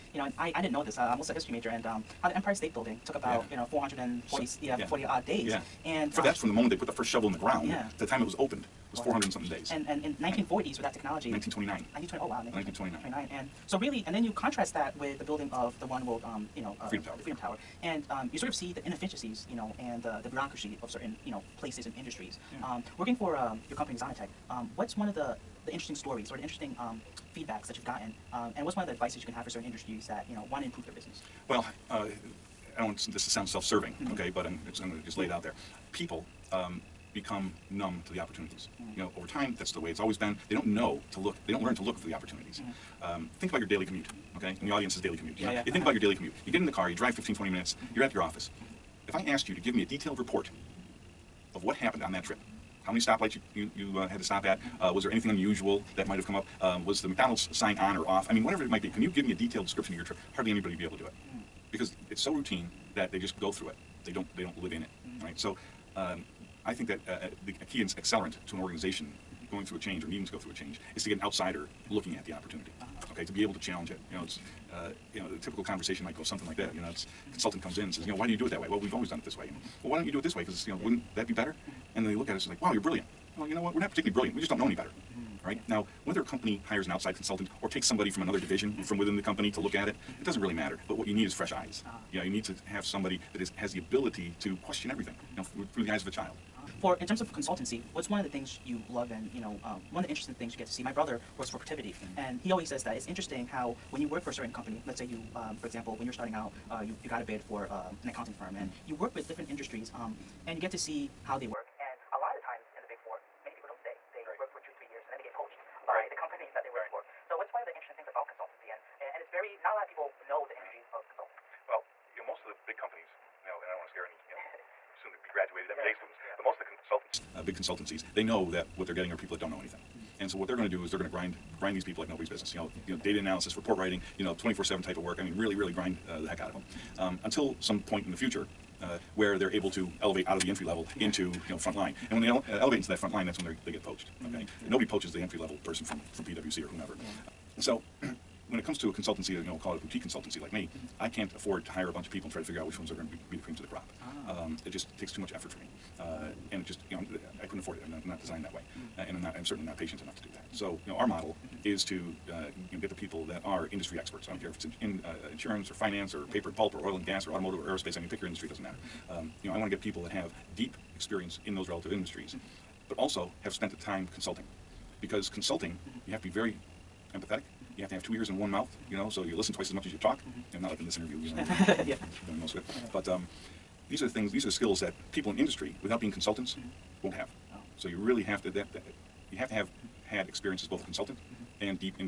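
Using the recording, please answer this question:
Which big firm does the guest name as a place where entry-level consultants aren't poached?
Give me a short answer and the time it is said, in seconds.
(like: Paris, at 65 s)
PwC, at 146 s.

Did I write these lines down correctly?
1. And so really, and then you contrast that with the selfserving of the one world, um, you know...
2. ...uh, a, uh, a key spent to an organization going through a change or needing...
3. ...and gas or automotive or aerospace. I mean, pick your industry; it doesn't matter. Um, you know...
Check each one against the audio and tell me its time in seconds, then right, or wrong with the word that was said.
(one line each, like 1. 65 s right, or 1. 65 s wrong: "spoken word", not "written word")
1. 13 s wrong: "building", not "selfserving"
2. 67 s wrong: "accelerant", not "spent"
3. 166 s right.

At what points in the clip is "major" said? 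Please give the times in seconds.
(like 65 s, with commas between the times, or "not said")
1 s.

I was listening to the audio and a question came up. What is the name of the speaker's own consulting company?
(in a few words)
XONITEK.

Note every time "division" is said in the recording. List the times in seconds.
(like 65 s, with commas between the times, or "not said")
88 s.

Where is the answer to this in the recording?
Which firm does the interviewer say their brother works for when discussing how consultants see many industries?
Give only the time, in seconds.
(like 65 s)
101 s.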